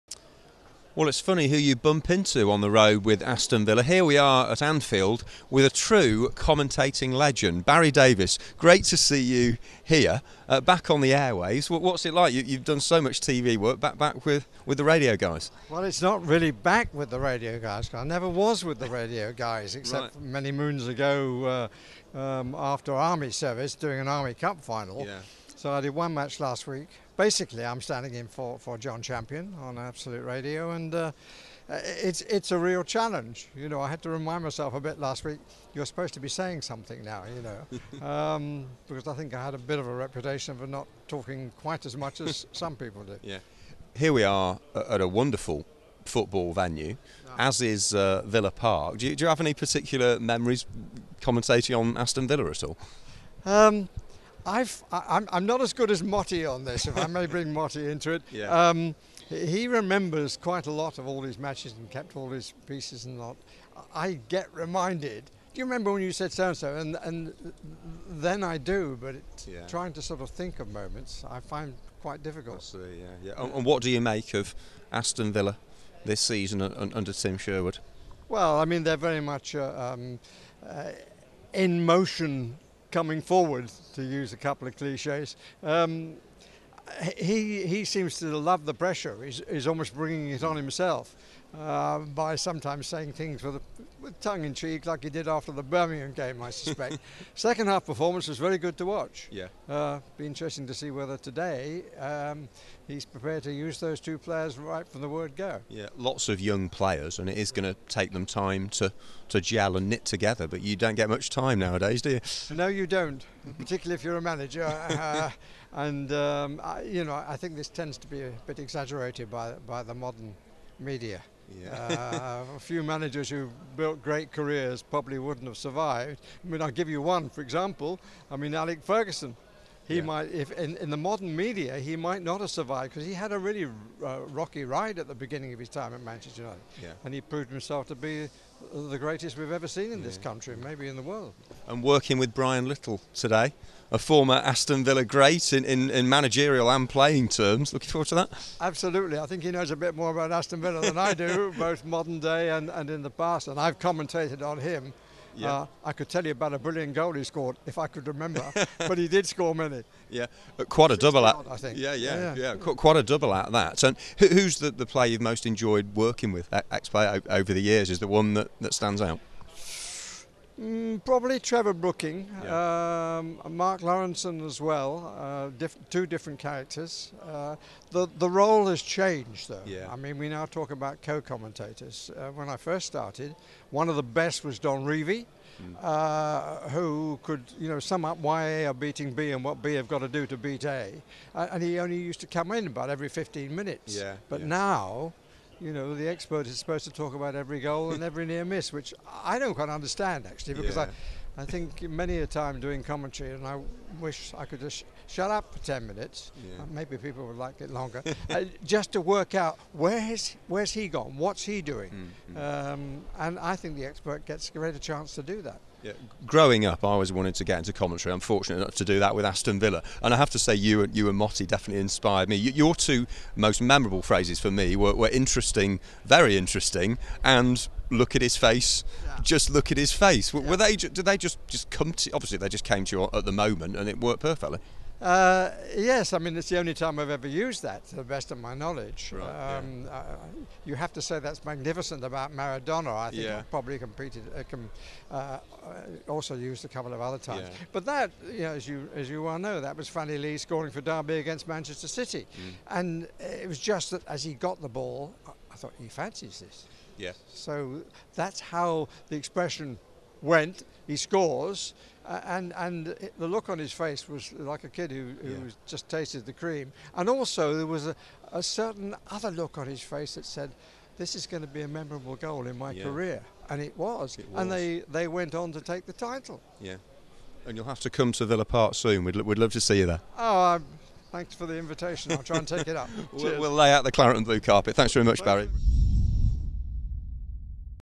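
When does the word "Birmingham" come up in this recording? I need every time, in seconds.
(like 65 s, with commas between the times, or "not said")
95 s.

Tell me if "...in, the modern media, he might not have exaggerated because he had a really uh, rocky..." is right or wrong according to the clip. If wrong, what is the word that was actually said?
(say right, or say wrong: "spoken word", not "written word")
wrong: "survived", not "exaggerated".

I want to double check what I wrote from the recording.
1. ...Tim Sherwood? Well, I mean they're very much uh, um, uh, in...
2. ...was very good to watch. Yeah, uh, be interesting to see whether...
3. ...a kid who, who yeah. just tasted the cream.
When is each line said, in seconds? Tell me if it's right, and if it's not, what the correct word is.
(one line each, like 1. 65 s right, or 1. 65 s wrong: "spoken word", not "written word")
1. 77 s right
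2. 98 s right
3. 264 s right.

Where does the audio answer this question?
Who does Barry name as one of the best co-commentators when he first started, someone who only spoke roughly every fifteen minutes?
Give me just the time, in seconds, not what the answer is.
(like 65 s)
184 s.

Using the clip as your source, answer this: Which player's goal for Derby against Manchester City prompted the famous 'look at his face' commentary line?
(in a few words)
Franny Lee.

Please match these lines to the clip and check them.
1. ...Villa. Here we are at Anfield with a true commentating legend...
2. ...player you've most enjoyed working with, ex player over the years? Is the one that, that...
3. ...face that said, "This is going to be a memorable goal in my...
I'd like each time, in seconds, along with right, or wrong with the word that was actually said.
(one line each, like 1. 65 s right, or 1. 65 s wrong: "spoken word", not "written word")
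1. 3 s right
2. 164 s right
3. 269 s right.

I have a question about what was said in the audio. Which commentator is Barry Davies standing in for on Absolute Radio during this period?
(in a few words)
Jon Champion.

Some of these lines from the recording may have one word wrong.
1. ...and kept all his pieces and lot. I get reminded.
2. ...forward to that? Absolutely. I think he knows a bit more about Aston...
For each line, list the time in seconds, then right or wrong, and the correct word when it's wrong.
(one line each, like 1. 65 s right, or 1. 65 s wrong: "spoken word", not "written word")
1. 61 s right
2. 147 s right.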